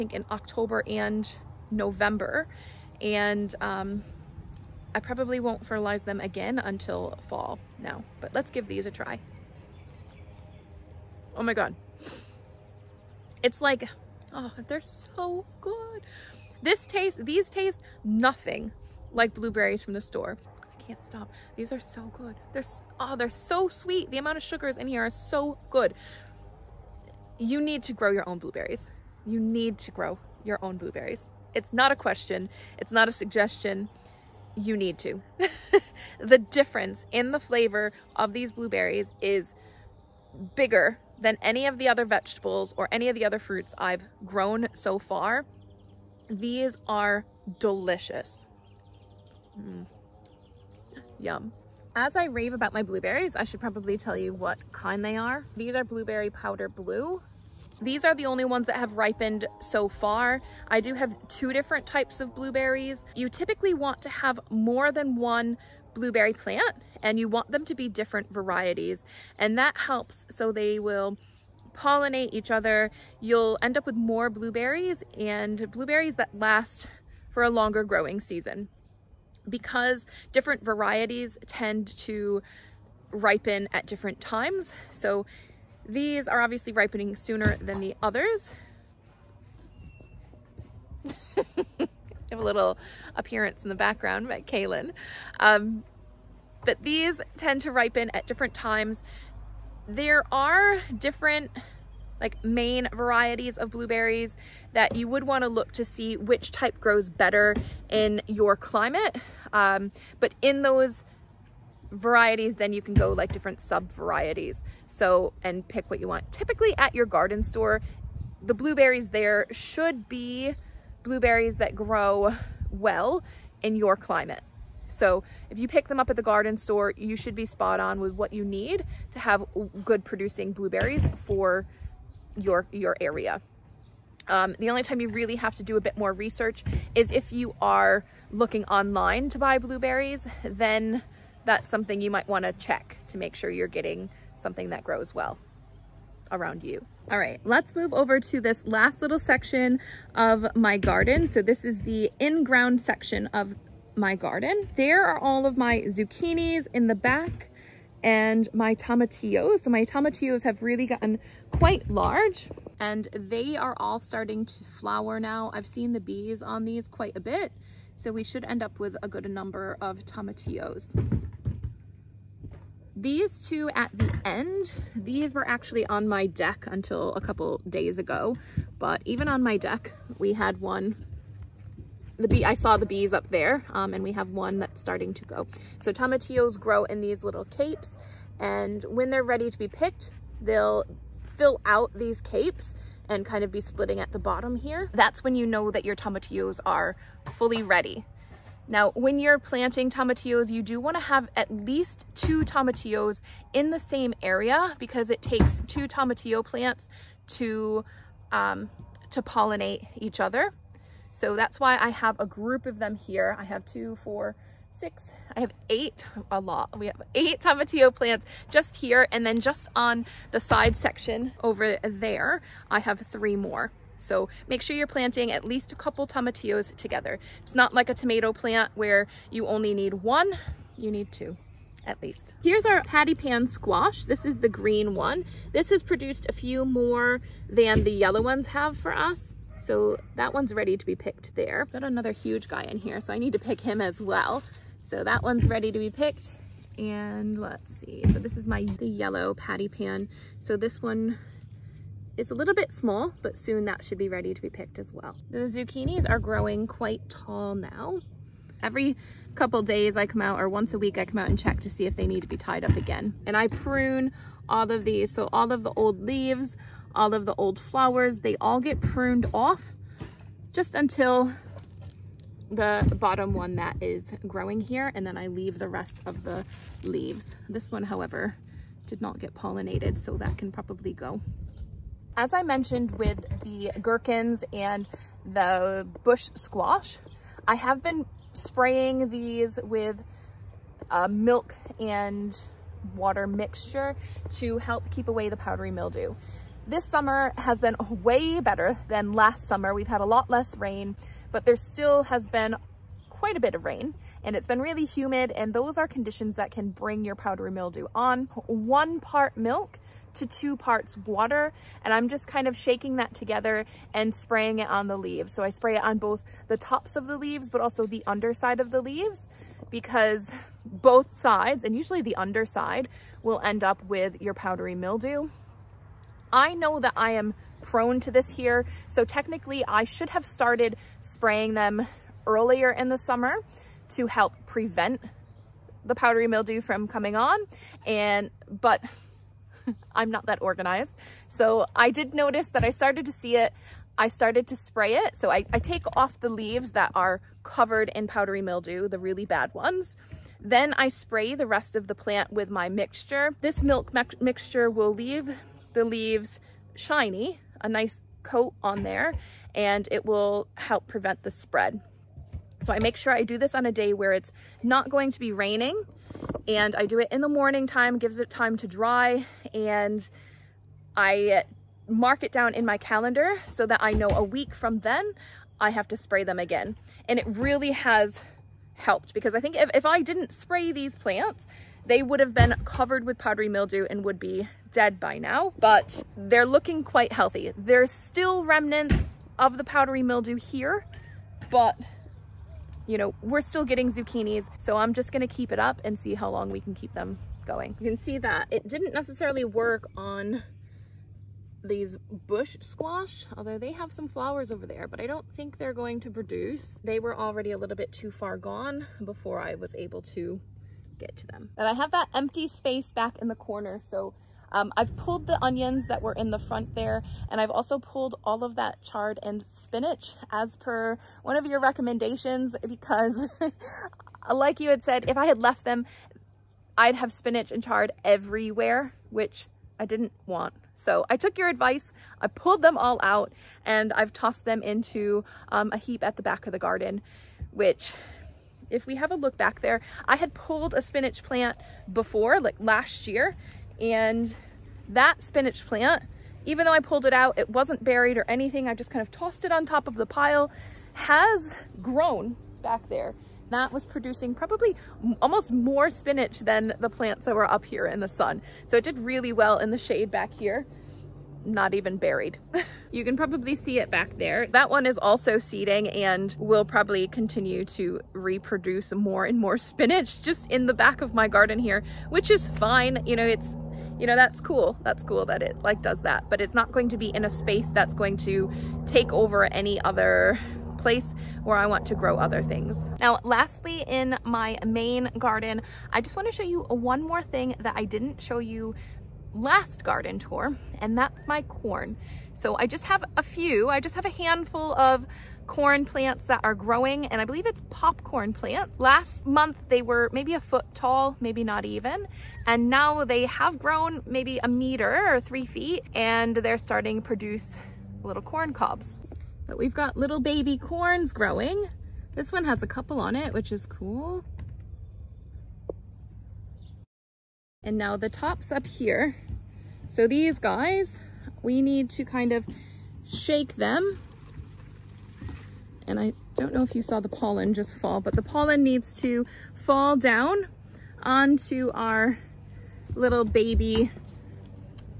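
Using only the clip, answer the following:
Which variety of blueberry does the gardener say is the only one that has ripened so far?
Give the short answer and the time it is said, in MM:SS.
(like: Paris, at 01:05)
Powder Blue, at 00:55.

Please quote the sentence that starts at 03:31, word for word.
So that's why I have a group of them here.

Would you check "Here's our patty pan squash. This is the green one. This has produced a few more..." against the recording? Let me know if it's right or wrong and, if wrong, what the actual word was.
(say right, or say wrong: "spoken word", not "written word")
right.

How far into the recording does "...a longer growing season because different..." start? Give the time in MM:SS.
01:17.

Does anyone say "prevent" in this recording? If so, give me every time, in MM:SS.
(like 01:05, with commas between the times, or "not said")
05:34, 06:00.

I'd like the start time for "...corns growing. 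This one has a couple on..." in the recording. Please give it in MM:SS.
08:30.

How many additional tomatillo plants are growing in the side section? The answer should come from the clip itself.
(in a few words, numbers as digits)
3.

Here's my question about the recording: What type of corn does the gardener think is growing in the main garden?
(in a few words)
popcorn.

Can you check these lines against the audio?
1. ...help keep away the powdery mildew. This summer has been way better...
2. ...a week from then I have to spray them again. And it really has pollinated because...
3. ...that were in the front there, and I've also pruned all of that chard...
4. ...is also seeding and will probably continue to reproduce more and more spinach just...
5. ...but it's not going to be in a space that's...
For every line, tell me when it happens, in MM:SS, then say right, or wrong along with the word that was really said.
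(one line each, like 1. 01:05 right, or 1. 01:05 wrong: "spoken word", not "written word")
1. 04:54 right
2. 06:14 wrong: "helped", not "pollinated"
3. 06:55 wrong: "pulled", not "pruned"
4. 07:44 right
5. 07:56 right.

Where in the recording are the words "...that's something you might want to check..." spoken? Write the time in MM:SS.
02:21.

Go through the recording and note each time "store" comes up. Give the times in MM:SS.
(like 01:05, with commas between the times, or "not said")
00:20, 01:57, 02:06.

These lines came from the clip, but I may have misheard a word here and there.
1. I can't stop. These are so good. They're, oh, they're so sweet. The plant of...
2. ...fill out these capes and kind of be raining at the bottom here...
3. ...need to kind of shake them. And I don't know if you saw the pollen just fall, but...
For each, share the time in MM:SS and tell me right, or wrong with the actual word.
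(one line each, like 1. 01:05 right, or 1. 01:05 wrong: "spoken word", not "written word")
1. 00:20 wrong: "amount", not "plant"
2. 03:11 wrong: "splitting", not "raining"
3. 08:41 right.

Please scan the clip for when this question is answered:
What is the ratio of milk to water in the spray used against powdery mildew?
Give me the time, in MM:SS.
05:08.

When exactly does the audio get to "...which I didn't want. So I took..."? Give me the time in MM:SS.
07:09.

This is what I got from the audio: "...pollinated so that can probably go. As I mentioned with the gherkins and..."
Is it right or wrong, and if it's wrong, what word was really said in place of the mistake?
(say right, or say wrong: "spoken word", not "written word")
right.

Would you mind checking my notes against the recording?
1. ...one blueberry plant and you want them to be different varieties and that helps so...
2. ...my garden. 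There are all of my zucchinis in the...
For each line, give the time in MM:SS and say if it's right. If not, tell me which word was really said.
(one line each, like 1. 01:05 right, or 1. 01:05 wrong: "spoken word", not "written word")
1. 01:05 right
2. 02:33 right.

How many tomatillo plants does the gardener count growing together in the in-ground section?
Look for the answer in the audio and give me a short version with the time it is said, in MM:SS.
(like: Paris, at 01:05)
8, at 03:37.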